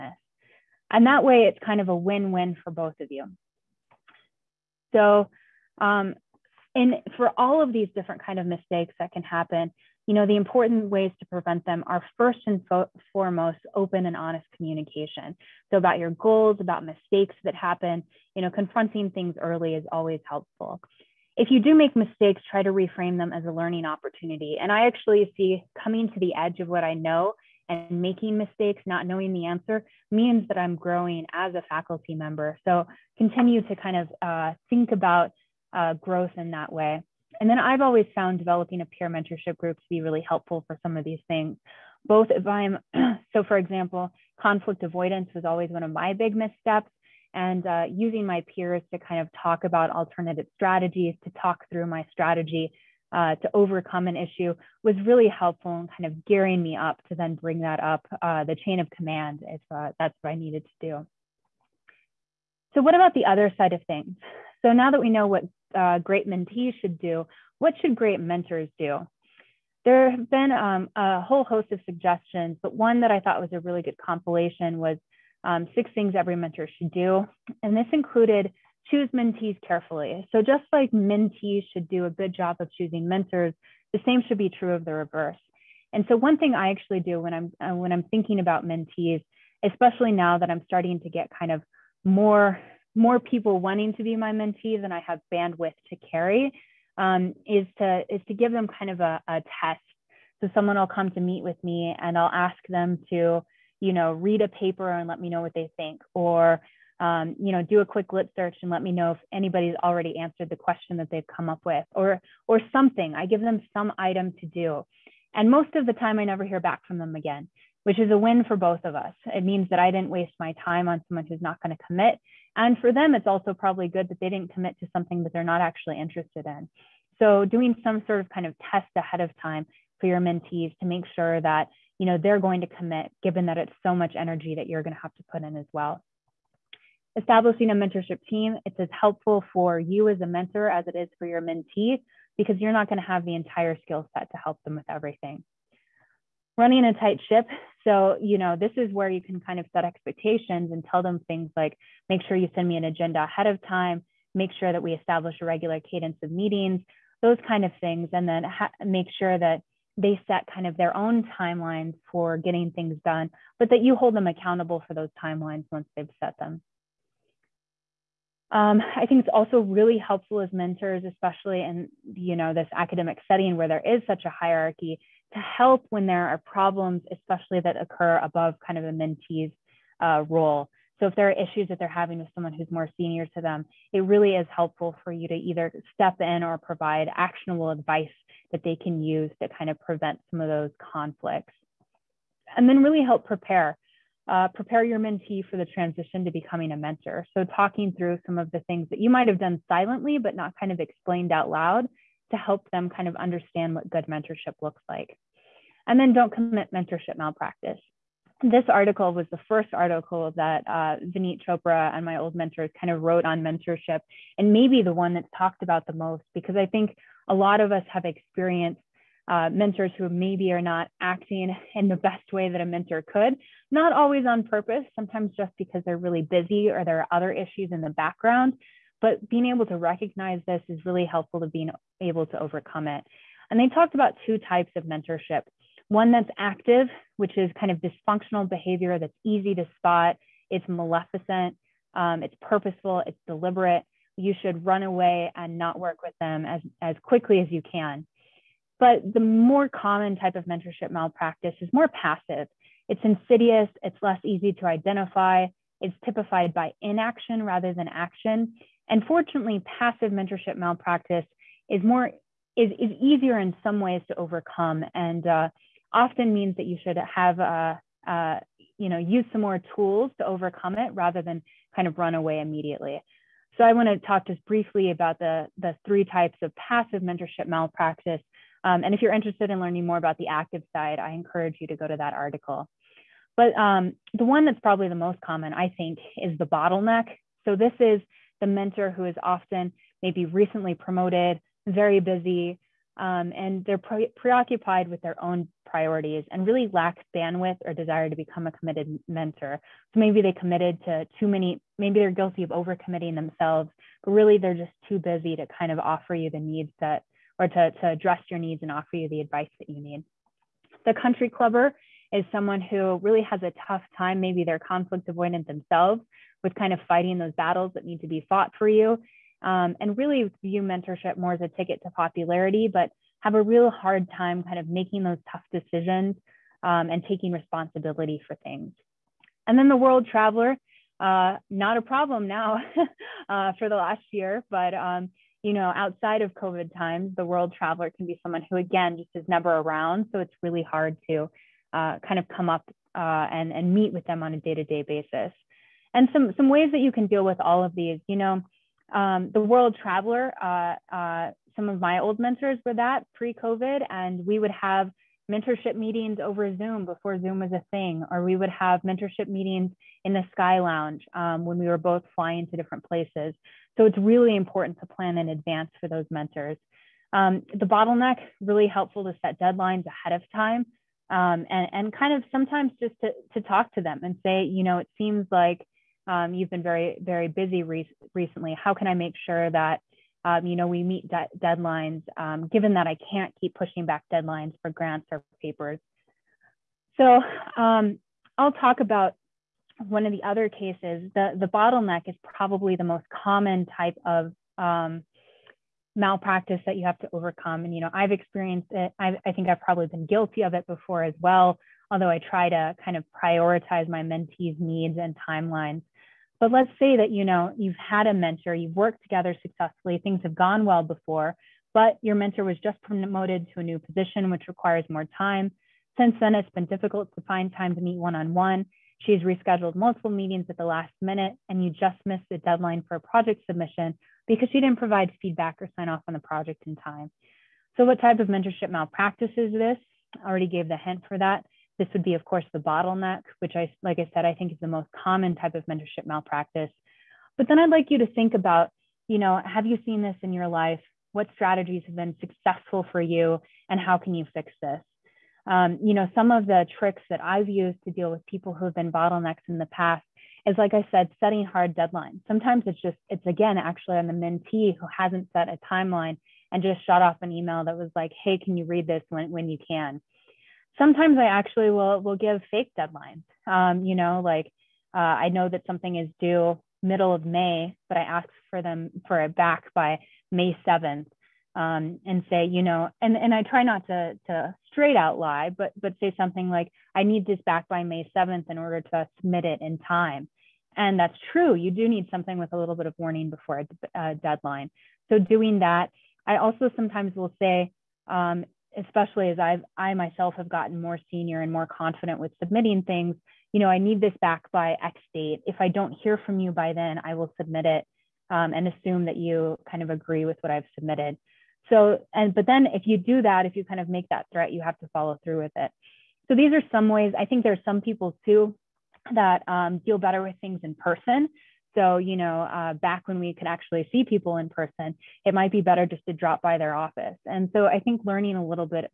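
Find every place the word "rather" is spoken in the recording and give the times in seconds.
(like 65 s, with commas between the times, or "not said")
257 s, 270 s.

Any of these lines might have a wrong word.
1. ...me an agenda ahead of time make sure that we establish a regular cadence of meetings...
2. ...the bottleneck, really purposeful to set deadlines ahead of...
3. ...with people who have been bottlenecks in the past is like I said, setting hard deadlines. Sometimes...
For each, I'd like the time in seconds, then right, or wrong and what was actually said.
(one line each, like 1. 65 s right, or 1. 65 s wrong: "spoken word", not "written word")
1. 152 s right
2. 367 s wrong: "helpful", not "purposeful"
3. 448 s right.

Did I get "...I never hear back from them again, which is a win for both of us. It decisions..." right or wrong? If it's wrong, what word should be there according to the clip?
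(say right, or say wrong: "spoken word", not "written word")
wrong: "means", not "decisions".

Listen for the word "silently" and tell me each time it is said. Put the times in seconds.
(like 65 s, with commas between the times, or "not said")
199 s.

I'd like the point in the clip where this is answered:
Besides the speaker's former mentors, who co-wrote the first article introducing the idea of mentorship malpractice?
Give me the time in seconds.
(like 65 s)
211 s.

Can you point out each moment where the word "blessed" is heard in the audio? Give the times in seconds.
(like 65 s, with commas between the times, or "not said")
not said.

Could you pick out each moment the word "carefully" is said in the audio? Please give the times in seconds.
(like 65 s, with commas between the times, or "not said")
79 s.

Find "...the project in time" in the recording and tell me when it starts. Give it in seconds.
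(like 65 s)
426 s.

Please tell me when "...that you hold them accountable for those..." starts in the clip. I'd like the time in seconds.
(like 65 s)
163 s.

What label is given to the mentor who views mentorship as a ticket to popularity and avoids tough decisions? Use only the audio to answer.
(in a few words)
The country clubber.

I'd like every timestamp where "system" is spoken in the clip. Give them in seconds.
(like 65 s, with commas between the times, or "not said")
not said.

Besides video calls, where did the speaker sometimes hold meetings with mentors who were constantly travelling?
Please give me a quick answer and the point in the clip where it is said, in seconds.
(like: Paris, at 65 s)
The Sky Lounge, at 360 s.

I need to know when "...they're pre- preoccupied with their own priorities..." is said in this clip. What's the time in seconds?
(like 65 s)
293 s.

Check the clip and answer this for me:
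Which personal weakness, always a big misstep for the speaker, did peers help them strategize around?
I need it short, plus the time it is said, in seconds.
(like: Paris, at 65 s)
Conflict avoidance, at 44 s.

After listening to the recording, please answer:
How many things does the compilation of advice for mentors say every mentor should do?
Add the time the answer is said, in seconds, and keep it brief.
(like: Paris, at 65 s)
6, at 75 s.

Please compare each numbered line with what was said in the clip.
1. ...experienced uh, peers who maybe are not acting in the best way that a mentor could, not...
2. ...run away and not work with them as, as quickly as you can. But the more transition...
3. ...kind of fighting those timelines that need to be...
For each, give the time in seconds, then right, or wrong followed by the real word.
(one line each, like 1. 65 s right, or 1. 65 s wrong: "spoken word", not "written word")
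1. 218 s wrong: "mentors", not "peers"
2. 244 s wrong: "common", not "transition"
3. 316 s wrong: "battles", not "timelines".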